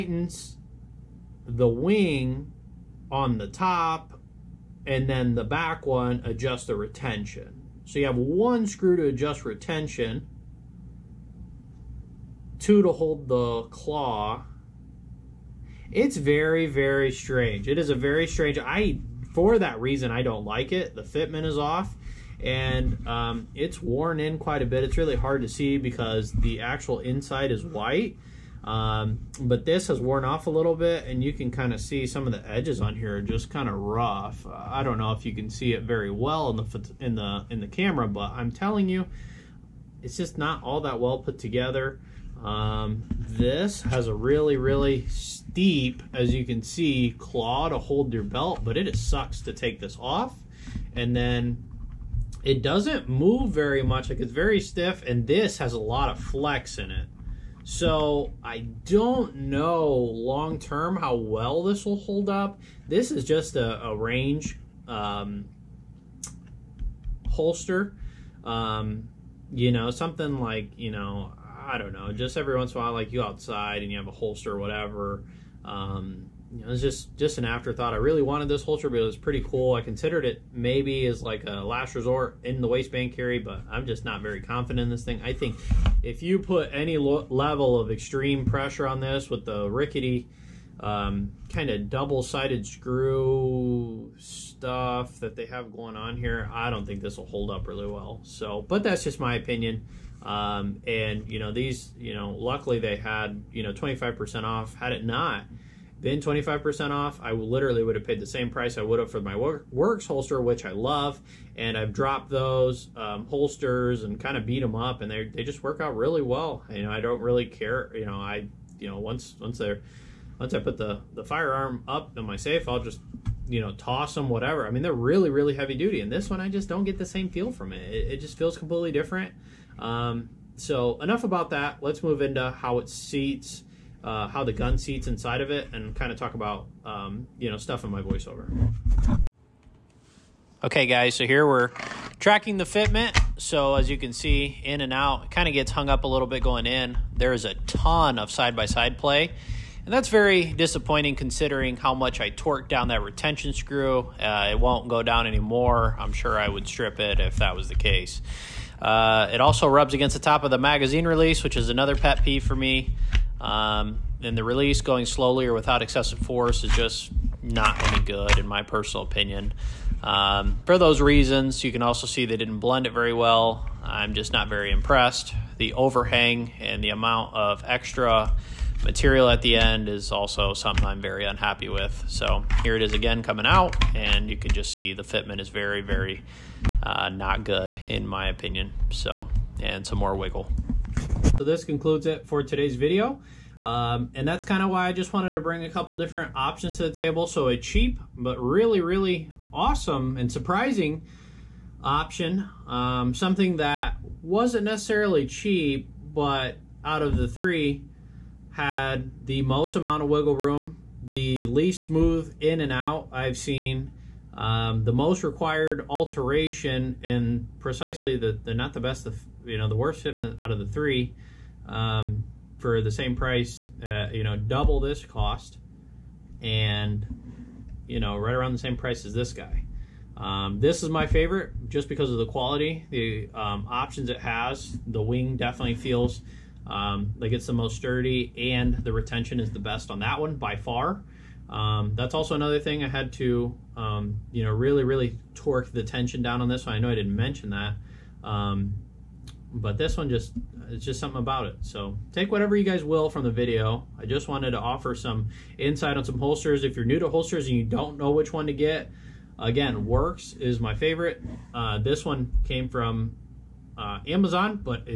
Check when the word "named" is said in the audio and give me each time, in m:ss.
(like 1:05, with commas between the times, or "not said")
not said.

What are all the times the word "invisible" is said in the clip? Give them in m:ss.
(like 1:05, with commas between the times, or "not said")
not said.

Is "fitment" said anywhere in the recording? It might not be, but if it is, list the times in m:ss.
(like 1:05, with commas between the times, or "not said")
0:21, 2:22, 3:05, 3:40.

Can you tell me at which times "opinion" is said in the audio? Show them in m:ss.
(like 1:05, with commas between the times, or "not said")
1:39, 2:49, 3:08.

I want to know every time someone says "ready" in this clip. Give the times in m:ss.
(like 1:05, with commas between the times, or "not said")
not said.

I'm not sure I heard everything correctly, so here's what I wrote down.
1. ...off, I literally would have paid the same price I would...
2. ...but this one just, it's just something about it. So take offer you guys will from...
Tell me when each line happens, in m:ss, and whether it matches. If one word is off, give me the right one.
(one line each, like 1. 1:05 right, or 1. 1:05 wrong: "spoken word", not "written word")
1. 1:46 right
2. 4:09 wrong: "whatever", not "offer".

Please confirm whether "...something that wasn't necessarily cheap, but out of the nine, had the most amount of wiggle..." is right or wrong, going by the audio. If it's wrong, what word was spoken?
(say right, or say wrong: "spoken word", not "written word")
wrong: "three", not "nine".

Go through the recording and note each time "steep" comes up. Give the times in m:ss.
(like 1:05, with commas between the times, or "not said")
0:45.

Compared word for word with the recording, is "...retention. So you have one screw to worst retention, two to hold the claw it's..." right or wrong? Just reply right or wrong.
wrong.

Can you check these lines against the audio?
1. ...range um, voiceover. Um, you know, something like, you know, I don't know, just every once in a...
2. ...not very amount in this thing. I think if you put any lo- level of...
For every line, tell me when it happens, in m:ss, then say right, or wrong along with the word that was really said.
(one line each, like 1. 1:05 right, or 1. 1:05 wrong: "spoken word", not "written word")
1. 1:03 wrong: "holster", not "voiceover"
2. 1:24 wrong: "confident", not "amount".